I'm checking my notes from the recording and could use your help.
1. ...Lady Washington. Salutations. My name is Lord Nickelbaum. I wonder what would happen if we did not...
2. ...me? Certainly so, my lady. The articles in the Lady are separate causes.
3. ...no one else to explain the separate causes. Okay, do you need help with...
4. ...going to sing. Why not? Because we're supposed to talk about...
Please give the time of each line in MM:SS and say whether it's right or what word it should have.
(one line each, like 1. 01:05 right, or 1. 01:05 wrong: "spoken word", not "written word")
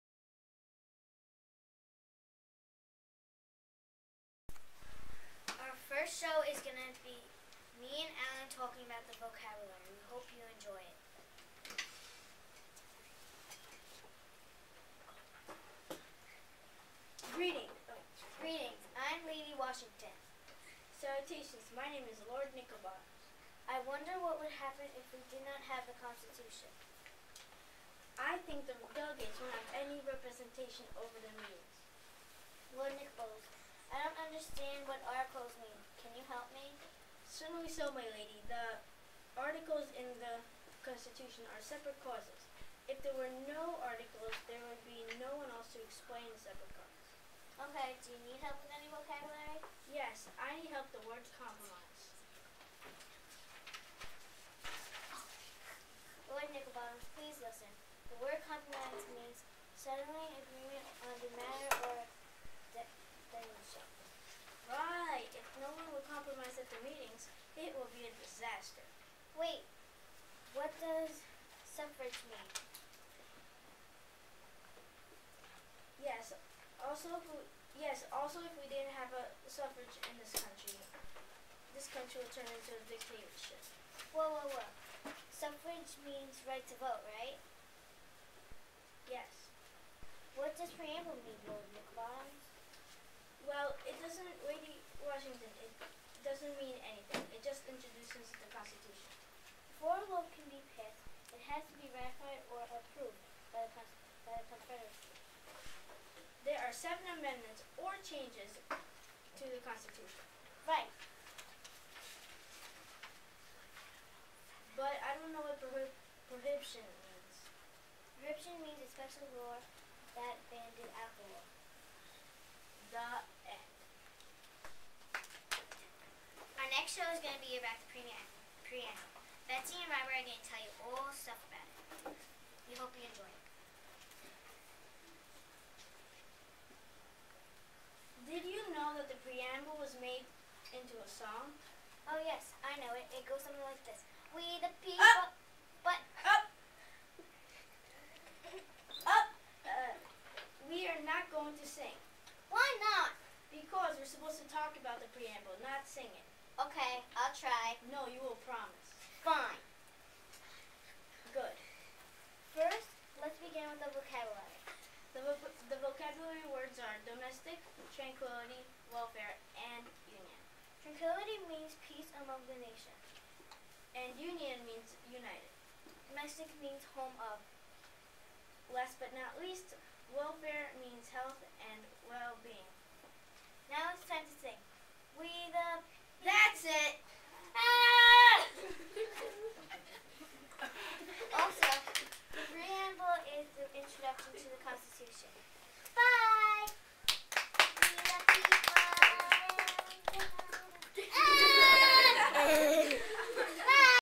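1. 00:19 right
2. 00:36 wrong: "Constitution", not "Lady"
3. 00:45 right
4. 02:31 right.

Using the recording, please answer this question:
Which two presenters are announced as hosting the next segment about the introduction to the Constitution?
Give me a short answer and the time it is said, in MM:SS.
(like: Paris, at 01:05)
Betsy and Robert, at 02:09.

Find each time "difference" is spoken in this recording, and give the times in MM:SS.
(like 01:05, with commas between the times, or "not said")
not said.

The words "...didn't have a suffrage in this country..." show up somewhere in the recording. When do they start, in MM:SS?
01:18.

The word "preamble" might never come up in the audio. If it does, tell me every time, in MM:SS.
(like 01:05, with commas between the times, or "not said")
02:07, 02:35, 03:12.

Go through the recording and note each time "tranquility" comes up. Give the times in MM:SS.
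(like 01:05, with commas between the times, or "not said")
02:47.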